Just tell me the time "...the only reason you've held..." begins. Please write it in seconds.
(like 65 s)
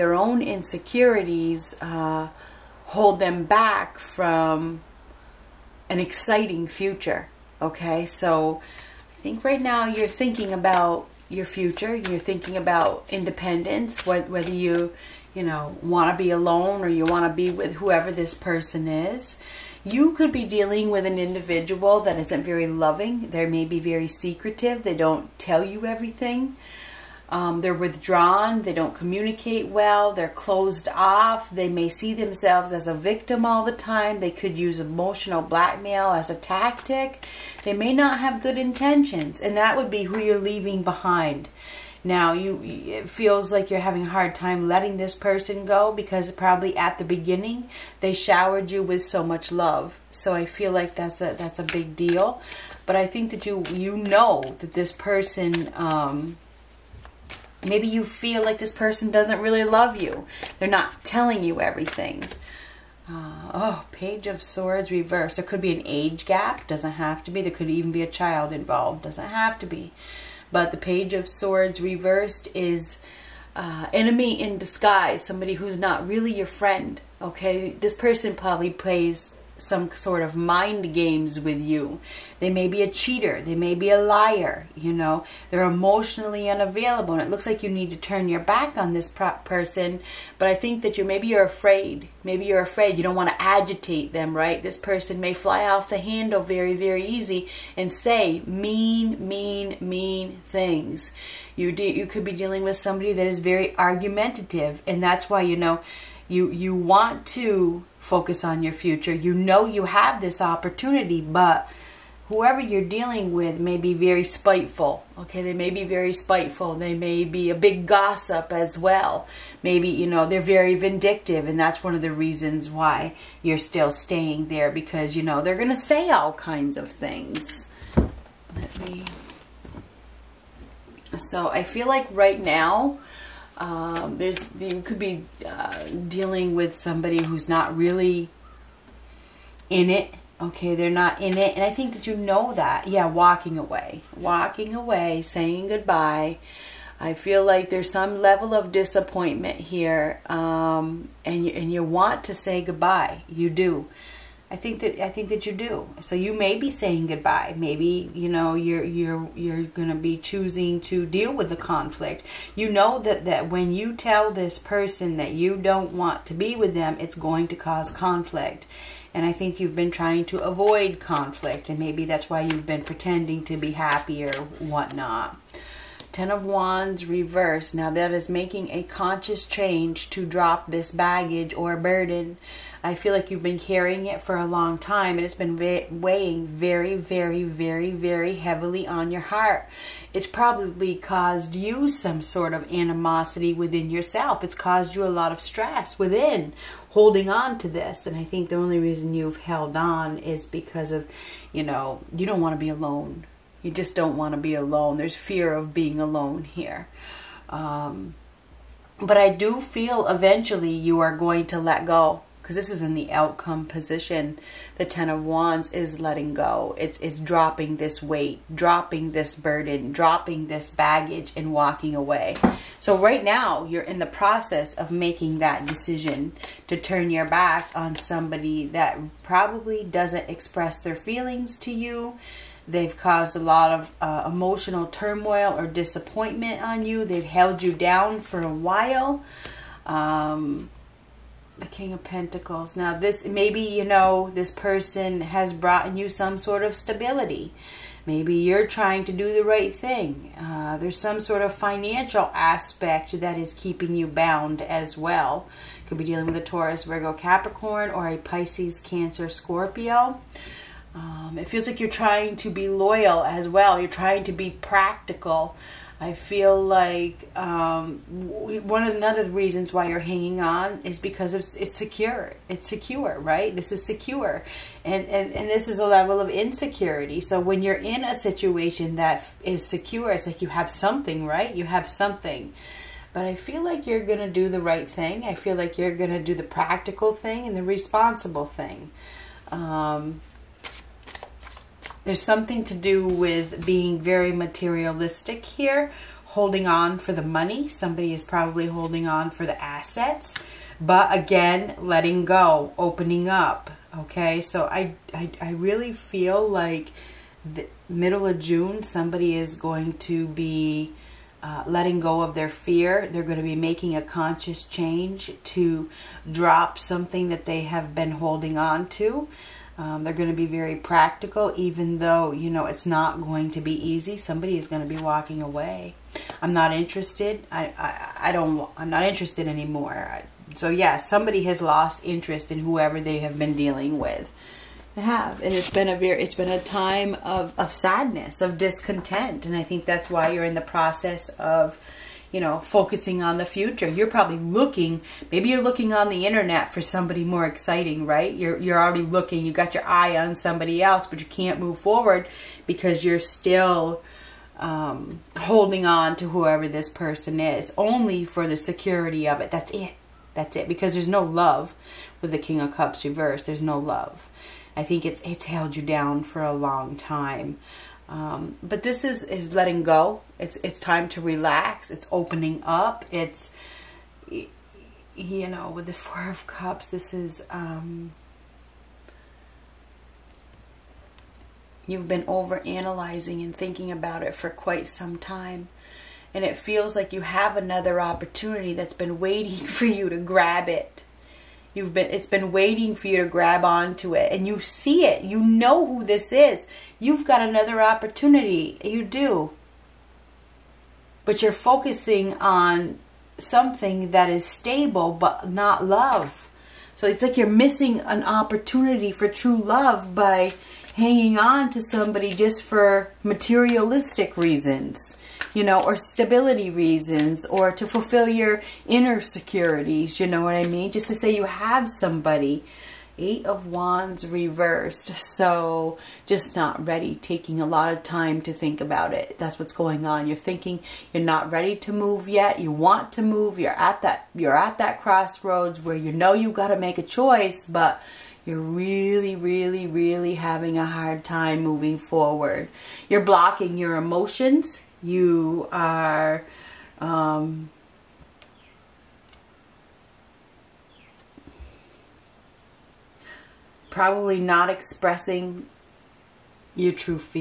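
198 s.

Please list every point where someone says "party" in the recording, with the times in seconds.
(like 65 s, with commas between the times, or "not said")
not said.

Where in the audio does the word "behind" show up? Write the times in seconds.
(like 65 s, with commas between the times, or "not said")
40 s.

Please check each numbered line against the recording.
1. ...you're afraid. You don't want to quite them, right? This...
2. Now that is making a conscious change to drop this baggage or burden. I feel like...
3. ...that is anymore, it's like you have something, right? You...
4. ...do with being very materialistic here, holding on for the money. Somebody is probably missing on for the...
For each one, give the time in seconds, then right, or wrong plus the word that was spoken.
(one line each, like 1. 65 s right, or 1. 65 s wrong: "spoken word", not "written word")
1. 92 s wrong: "agitate", not "quite"
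2. 177 s right
3. 278 s wrong: "secure", not "anymore"
4. 292 s wrong: "holding", not "missing".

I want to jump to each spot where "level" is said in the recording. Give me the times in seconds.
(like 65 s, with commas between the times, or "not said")
148 s, 275 s.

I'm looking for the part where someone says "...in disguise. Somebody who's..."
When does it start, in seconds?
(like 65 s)
74 s.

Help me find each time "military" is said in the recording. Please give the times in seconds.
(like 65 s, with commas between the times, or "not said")
not said.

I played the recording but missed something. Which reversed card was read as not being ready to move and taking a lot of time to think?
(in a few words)
Eight of Wands.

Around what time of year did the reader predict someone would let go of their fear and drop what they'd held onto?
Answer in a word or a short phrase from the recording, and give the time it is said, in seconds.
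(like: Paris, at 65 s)
Middle of June, at 307 s.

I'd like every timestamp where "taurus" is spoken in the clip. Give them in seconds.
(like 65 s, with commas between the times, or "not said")
256 s.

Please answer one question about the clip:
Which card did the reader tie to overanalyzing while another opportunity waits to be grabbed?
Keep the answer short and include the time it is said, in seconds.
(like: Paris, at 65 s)
Four of Cups, at 375 s.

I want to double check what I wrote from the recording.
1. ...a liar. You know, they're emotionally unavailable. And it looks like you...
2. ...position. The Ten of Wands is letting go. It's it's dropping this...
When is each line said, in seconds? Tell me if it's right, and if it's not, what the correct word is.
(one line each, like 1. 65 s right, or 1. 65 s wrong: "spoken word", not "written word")
1. 83 s right
2. 213 s right.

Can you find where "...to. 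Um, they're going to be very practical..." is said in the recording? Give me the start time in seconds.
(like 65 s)
318 s.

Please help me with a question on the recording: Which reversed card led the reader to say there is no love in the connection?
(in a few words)
King of Cups.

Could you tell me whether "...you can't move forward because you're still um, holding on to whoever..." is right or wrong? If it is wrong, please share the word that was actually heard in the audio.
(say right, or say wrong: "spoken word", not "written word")
right.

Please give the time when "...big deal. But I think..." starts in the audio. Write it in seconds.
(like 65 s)
51 s.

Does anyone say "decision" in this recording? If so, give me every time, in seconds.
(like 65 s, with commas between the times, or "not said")
225 s.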